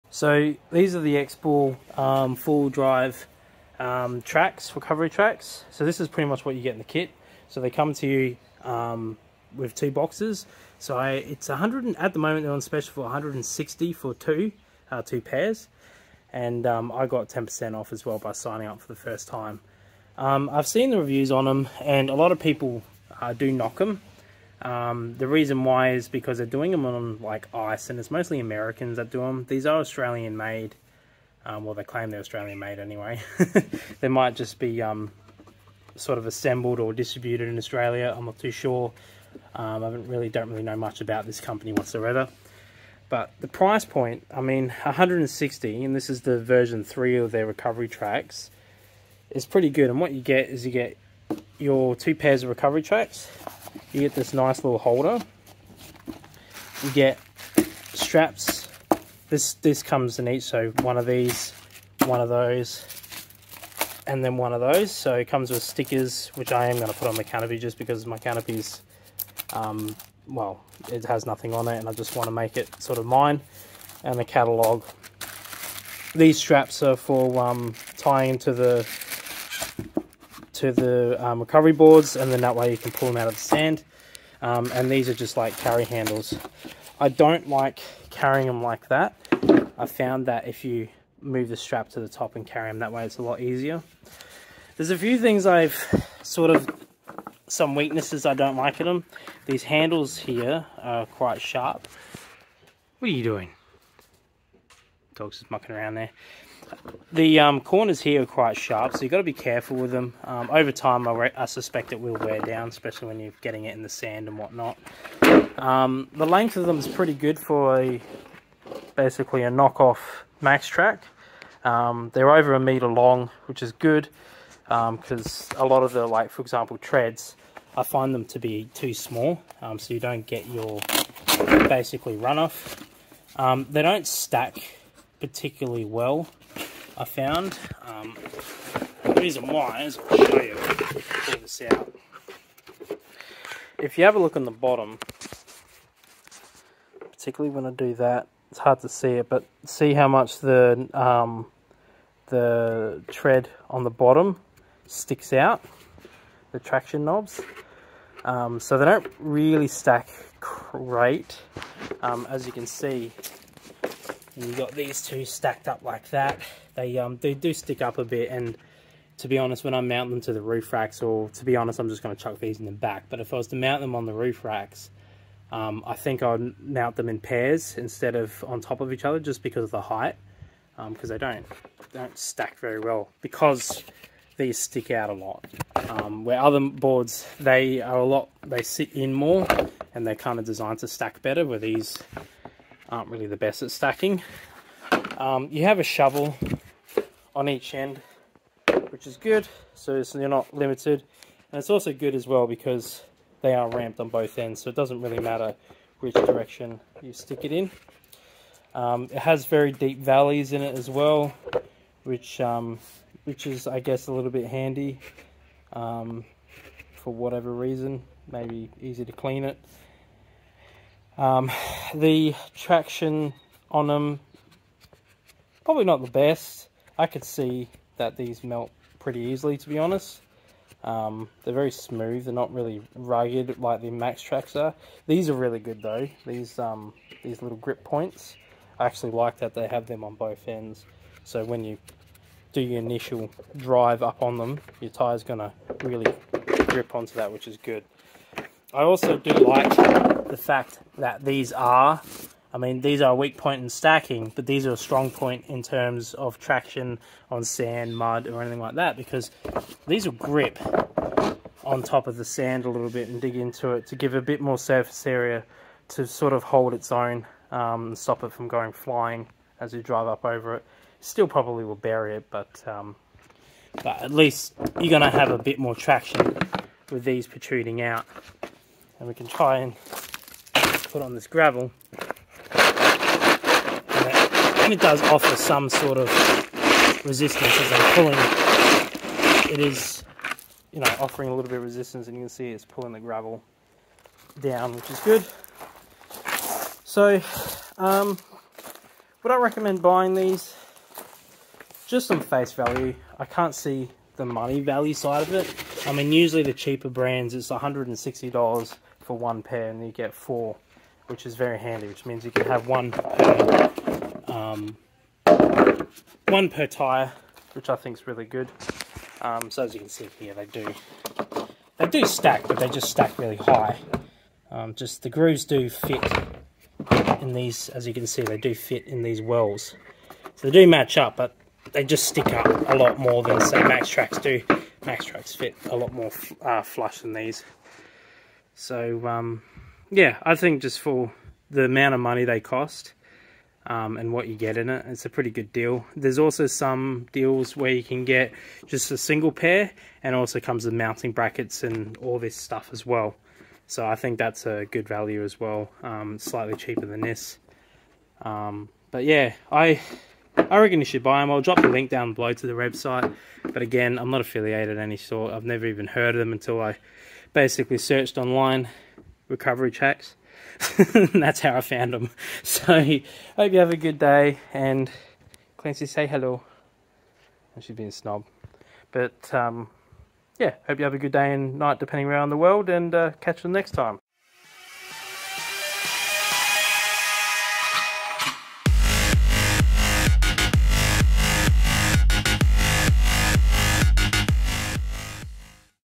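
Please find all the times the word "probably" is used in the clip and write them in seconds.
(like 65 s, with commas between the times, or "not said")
225 s, 271 s.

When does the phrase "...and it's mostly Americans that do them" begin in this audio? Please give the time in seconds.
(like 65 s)
27 s.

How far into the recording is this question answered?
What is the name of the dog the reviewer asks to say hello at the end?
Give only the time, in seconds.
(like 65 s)
375 s.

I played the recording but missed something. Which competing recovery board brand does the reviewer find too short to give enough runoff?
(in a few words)
TREDs.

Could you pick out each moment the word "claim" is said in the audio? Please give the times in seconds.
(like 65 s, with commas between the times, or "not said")
31 s.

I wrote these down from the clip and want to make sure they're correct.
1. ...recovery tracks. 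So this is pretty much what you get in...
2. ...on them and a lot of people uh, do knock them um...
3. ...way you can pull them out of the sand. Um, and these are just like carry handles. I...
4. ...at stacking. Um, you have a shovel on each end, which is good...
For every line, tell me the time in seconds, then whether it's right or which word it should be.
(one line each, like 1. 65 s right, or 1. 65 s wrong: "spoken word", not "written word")
1. 4 s right
2. 21 s right
3. 82 s right
4. 193 s right.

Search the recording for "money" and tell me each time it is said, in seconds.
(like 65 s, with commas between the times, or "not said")
304 s, 341 s.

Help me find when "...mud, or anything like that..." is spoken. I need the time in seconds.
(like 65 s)
257 s.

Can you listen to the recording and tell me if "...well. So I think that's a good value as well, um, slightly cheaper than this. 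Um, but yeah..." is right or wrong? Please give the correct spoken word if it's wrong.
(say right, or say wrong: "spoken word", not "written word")
right.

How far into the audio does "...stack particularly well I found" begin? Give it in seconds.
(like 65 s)
134 s.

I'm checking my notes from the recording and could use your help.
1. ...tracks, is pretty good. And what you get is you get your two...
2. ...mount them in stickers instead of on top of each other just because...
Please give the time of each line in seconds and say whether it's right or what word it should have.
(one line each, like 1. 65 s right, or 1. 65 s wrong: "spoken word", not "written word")
1. 47 s right
2. 176 s wrong: "pairs", not "stickers".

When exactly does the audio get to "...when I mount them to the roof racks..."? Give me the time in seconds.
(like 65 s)
169 s.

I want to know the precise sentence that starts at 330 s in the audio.
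So they do match up, but they just stick up a lot more than say Max Tracks do.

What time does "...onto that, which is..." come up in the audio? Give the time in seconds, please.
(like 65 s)
246 s.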